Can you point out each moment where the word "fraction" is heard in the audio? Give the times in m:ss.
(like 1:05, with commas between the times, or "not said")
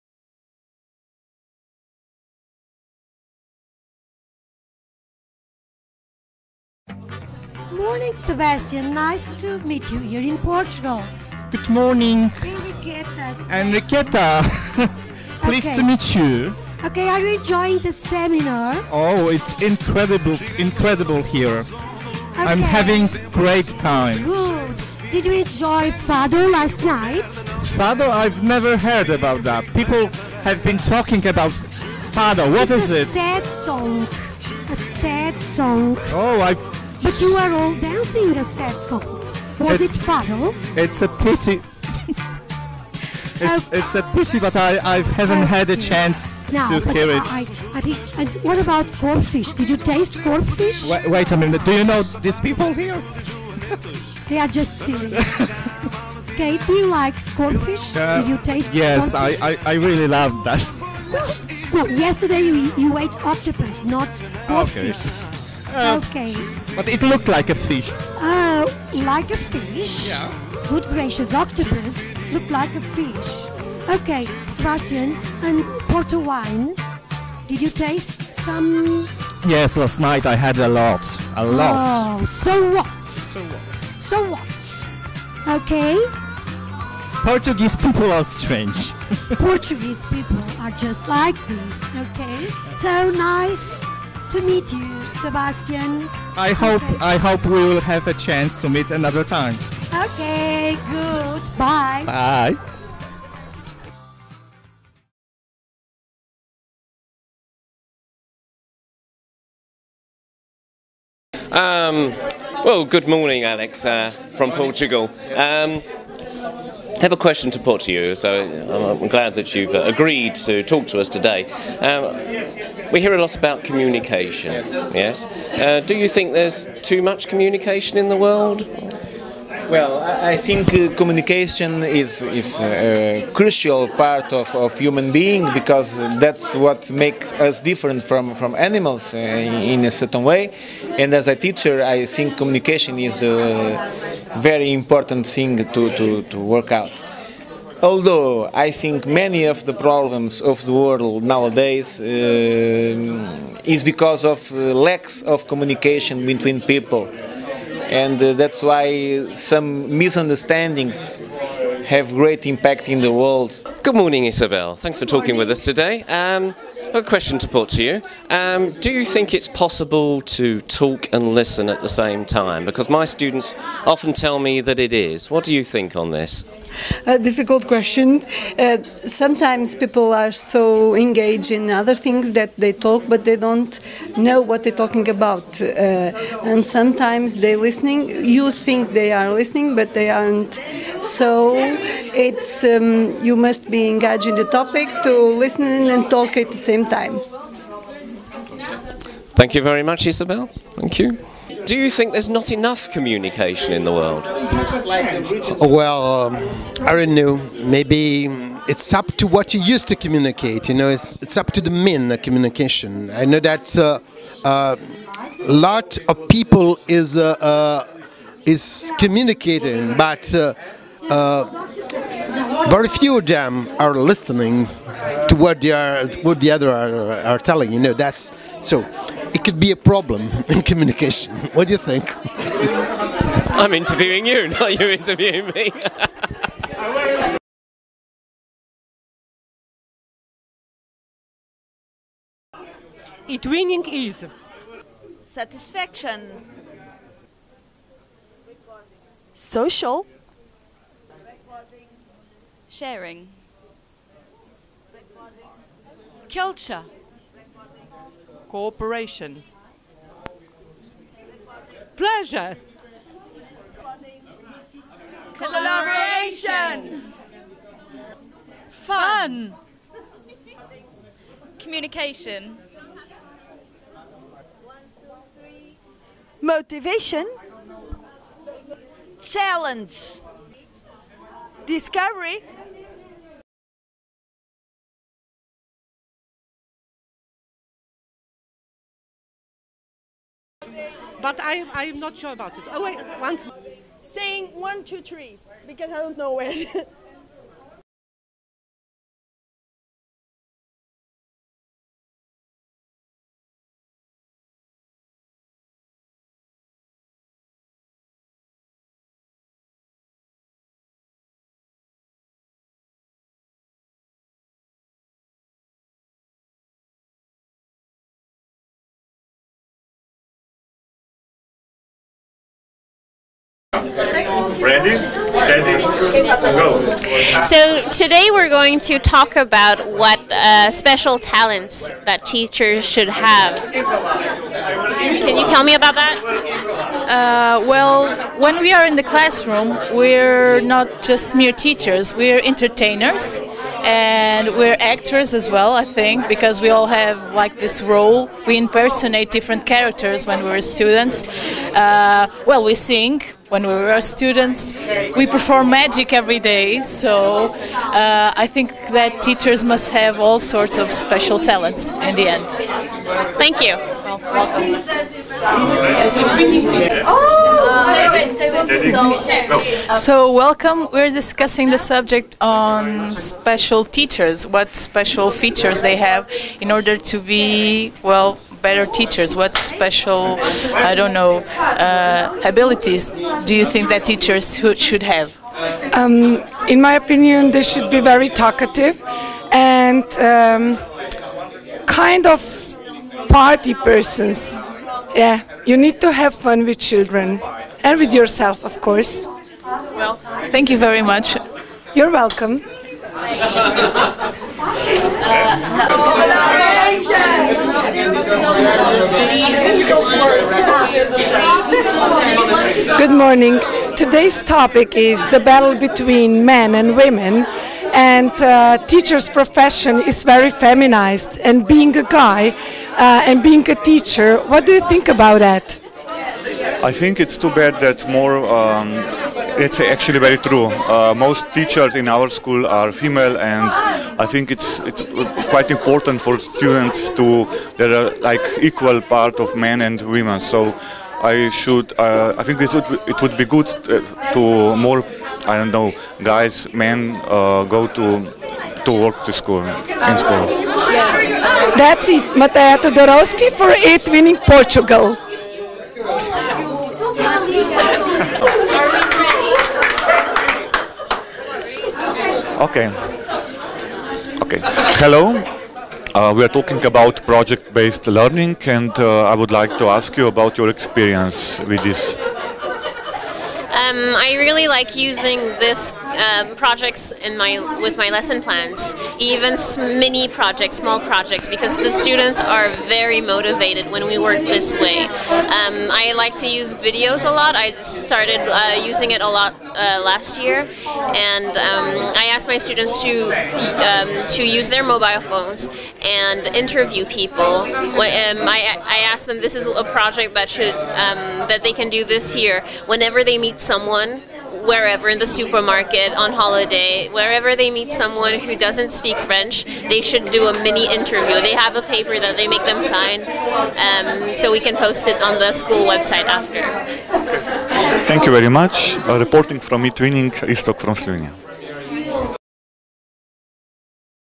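not said.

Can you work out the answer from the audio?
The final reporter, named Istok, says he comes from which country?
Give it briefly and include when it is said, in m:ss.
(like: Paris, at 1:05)
Slovenia, at 8:40.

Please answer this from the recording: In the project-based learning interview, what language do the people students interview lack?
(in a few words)
French.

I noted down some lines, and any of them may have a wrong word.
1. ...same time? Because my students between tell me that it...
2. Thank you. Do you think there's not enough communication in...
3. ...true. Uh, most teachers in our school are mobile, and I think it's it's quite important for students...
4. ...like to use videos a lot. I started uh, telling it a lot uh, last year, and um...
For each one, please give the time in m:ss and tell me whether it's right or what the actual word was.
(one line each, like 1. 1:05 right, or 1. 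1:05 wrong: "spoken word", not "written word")
1. 2:51 wrong: "often", not "between"
2. 3:20 right
3. 7:10 wrong: "female", not "mobile"
4. 8:06 wrong: "using", not "telling".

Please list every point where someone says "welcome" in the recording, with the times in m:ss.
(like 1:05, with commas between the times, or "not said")
6:10, 6:42.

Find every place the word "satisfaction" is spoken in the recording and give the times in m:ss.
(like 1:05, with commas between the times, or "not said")
4:05.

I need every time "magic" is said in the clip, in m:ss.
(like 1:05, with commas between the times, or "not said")
5:55.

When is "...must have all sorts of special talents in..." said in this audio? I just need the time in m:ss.
5:59.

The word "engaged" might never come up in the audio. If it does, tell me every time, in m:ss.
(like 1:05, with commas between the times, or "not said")
3:00, 3:13.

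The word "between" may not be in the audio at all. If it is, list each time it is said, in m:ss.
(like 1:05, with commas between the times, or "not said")
2:36, 6:55.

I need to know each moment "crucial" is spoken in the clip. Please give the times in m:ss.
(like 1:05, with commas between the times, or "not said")
2:13.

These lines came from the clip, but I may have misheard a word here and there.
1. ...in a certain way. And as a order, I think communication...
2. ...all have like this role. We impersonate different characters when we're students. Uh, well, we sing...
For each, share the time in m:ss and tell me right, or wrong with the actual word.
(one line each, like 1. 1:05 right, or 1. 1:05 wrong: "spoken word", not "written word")
1. 2:19 wrong: "teacher", not "order"
2. 5:46 right.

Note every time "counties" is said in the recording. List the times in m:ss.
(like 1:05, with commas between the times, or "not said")
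not said.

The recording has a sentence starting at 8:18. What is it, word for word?
Um, I, I asked them this is a project that should um, that they can do this year.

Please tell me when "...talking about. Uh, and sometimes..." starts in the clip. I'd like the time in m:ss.
3:04.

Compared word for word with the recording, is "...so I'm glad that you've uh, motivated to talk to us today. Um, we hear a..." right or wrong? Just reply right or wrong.
wrong.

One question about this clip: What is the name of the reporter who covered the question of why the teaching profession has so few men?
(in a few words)
Mateja Todorowski.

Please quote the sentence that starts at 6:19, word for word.
What special, I don't know, uh, abilities do you think that teachers should have?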